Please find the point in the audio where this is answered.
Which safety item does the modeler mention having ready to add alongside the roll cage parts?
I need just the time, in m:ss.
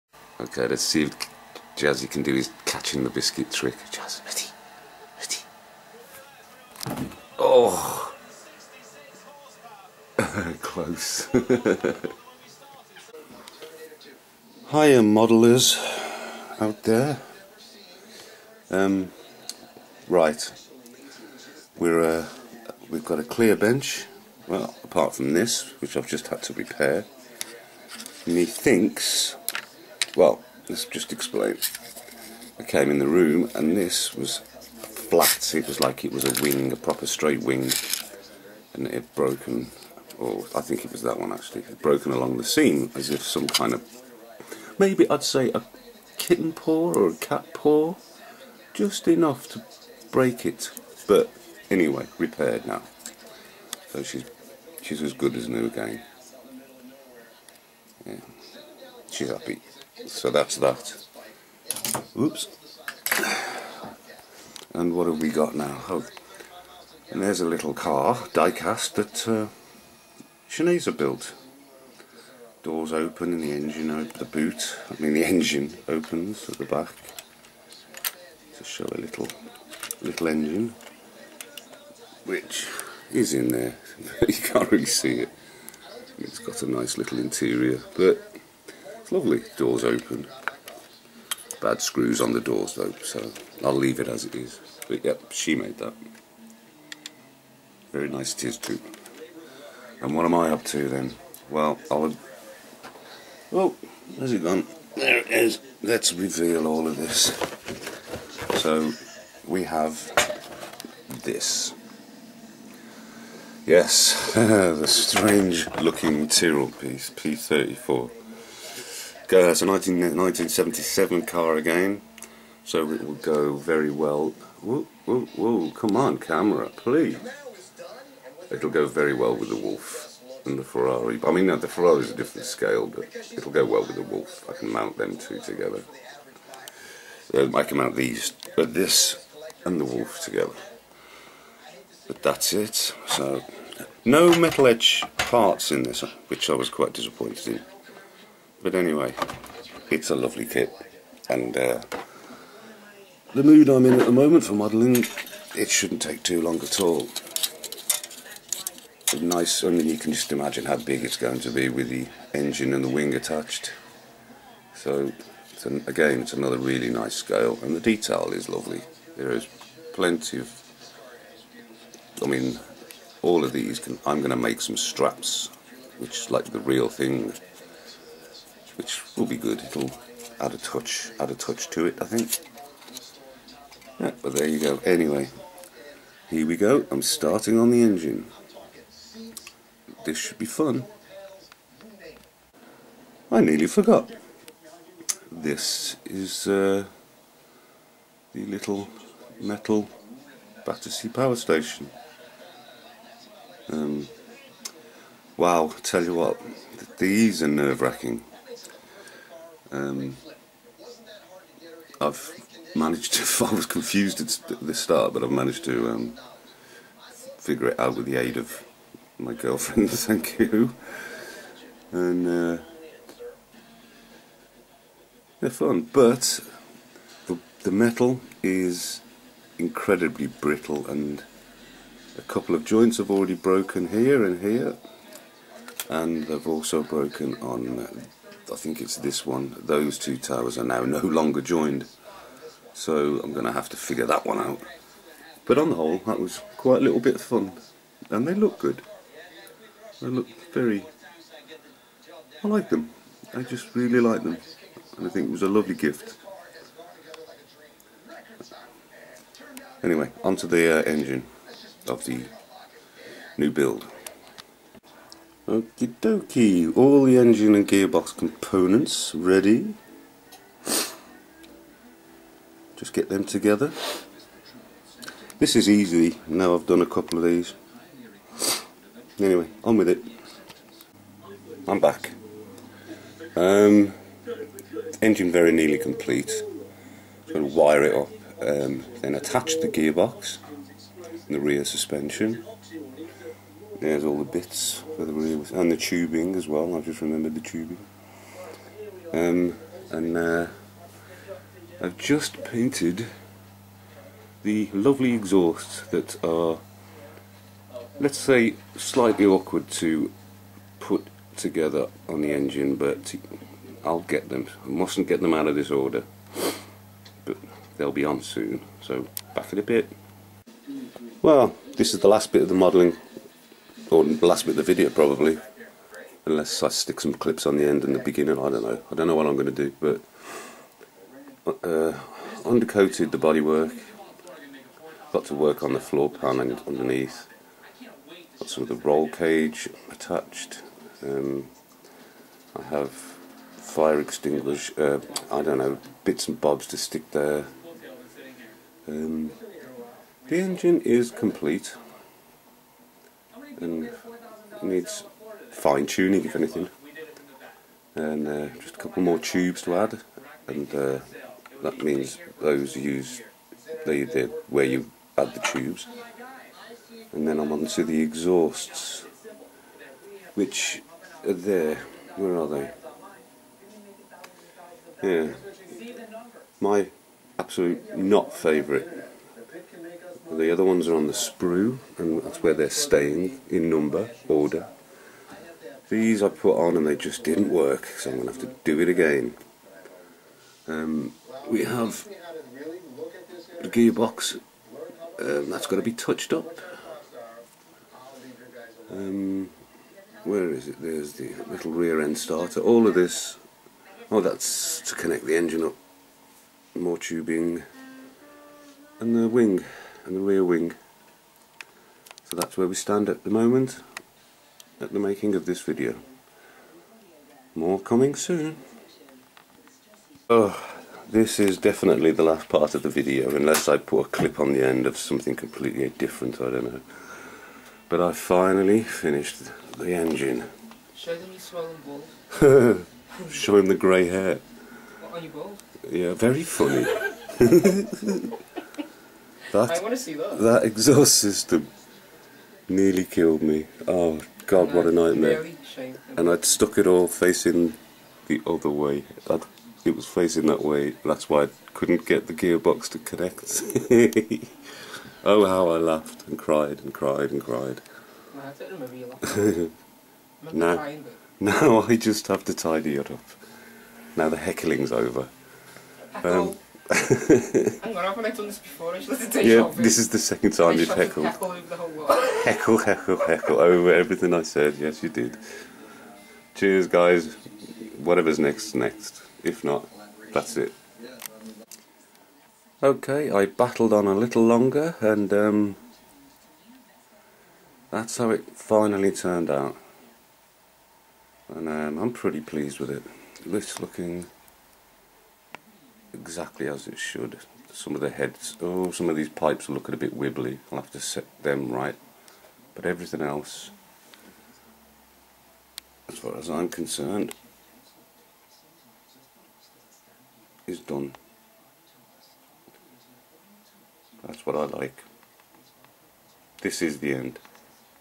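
5:42.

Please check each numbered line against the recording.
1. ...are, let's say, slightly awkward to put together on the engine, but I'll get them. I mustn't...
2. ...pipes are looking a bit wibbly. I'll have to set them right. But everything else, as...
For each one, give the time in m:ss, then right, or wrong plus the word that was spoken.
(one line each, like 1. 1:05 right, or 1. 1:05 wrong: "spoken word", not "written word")
1. 5:06 right
2. 8:19 right.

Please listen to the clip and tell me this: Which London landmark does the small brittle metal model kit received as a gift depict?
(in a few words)
Battersea power station.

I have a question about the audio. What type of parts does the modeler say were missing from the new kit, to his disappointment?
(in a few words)
Metal etch parts.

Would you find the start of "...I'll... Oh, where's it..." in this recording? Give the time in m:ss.
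1:41.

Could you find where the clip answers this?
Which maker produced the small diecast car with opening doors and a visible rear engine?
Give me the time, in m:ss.
1:10.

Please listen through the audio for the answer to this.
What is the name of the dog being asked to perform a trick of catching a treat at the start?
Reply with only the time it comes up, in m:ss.
0:01.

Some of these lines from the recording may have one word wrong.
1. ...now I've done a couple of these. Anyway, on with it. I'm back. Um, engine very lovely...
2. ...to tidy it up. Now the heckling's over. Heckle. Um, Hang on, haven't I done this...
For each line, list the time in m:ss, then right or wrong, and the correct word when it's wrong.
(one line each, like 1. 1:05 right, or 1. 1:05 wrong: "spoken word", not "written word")
1. 4:36 wrong: "nearly", not "lovely"
2. 7:42 right.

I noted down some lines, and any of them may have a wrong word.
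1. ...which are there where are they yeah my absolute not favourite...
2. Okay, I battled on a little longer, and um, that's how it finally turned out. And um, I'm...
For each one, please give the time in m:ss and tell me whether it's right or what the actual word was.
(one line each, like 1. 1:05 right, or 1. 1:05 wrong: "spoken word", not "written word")
1. 6:10 right
2. 8:02 right.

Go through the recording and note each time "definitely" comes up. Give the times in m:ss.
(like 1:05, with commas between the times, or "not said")
7:01.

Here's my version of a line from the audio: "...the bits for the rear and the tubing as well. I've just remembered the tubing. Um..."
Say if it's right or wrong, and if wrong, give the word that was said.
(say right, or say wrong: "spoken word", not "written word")
right.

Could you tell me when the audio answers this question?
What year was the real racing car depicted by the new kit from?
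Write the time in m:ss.
1:59.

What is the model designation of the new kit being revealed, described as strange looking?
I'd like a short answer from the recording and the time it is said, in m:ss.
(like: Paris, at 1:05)
P34, at 1:57.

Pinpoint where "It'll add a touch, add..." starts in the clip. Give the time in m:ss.
2:59.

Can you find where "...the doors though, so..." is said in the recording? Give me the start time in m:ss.
1:32.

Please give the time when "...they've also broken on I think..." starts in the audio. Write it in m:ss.
3:56.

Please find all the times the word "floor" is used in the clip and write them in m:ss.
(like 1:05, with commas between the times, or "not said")
5:35.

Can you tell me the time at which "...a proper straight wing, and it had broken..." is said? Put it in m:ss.
0:36.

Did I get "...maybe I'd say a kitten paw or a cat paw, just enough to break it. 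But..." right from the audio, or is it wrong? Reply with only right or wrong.
right.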